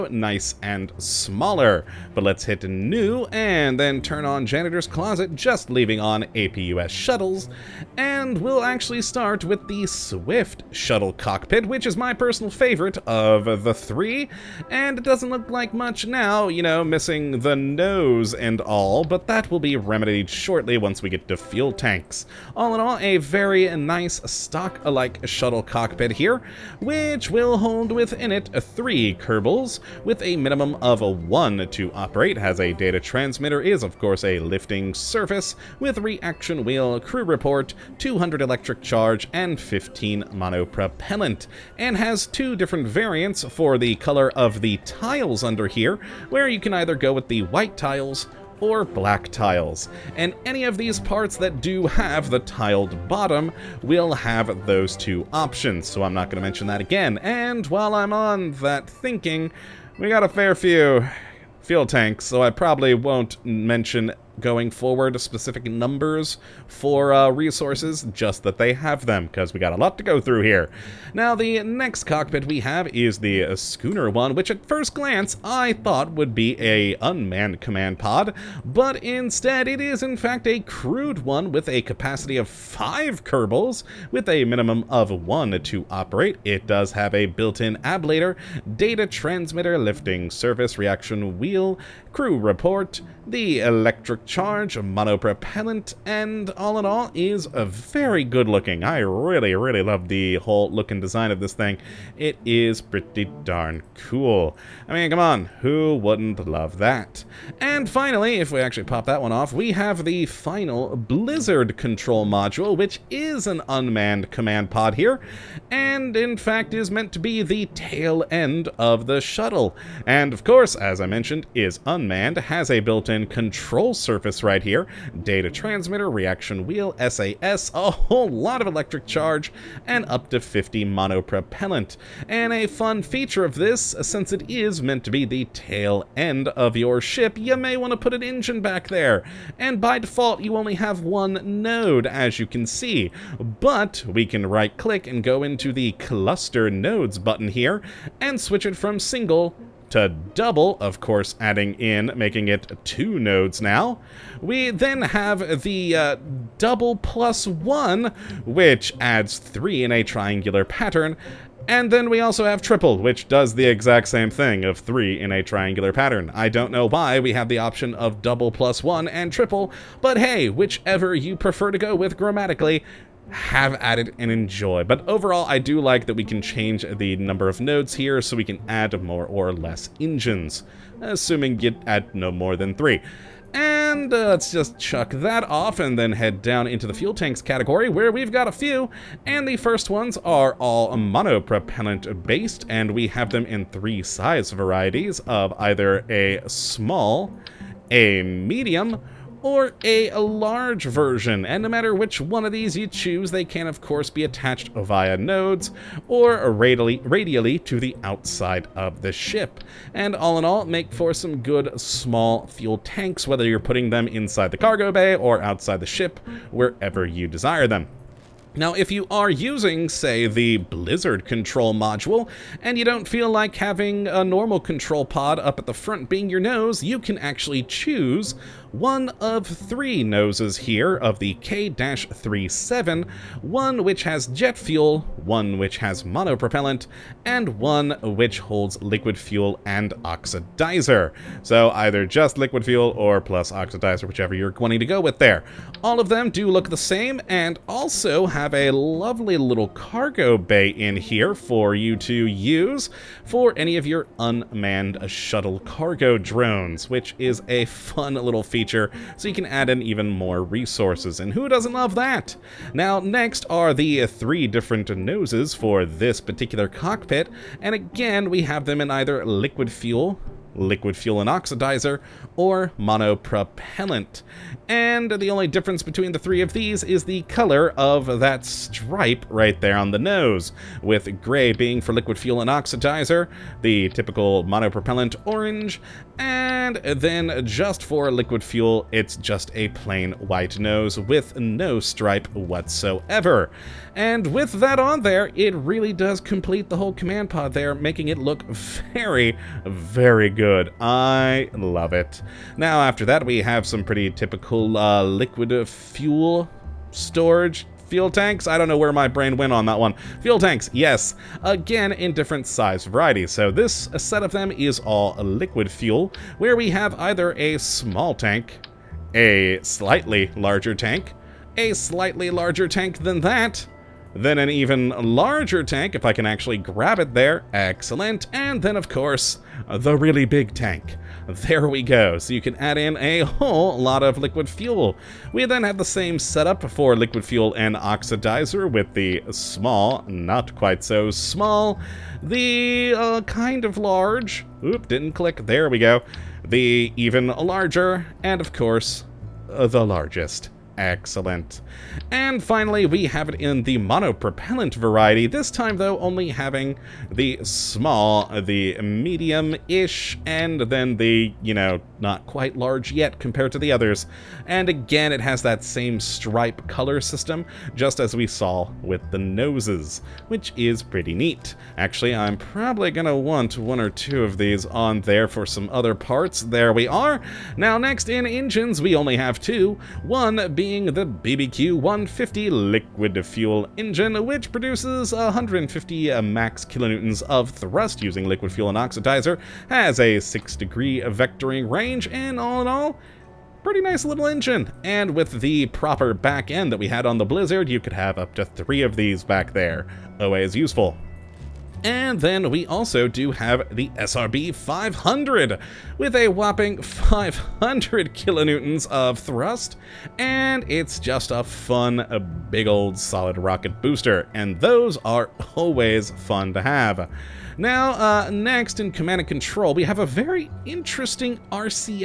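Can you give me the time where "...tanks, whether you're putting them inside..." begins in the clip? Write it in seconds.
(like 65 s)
212 s.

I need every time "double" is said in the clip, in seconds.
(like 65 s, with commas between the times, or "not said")
150 s, 156 s, 168 s.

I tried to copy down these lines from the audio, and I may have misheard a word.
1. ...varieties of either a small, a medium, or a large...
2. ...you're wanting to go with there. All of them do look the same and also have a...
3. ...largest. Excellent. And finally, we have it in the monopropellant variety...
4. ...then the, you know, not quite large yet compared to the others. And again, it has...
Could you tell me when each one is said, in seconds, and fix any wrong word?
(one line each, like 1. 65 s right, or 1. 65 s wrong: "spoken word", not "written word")
1. 194 s right
2. 244 s right
3. 349 s right
4. 360 s right.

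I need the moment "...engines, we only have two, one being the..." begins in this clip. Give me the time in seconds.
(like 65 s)
378 s.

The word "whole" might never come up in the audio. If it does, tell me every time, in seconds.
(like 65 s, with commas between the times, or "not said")
100 s, 127 s, 296 s, 333 s.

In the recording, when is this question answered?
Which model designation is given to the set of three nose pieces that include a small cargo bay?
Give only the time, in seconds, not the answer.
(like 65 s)
231 s.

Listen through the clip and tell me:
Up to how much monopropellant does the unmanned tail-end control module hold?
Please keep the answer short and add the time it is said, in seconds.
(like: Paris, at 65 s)
50, at 130 s.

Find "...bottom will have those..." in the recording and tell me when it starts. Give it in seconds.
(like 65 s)
53 s.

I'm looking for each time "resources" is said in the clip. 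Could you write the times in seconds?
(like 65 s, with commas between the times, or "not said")
67 s, 260 s.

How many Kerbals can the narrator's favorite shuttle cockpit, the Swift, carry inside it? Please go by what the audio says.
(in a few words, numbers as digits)
3.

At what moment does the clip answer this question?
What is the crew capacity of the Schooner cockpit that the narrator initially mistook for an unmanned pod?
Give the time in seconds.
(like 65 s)
82 s.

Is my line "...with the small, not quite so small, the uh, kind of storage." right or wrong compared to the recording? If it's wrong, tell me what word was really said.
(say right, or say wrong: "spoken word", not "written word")
wrong: "large", not "storage".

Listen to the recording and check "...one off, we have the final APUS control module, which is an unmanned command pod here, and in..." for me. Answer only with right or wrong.
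wrong.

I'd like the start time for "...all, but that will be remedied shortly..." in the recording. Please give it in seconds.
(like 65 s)
18 s.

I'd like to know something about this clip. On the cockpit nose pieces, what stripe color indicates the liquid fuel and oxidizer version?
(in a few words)
gray.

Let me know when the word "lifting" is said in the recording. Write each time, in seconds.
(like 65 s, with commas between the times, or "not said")
34 s, 89 s.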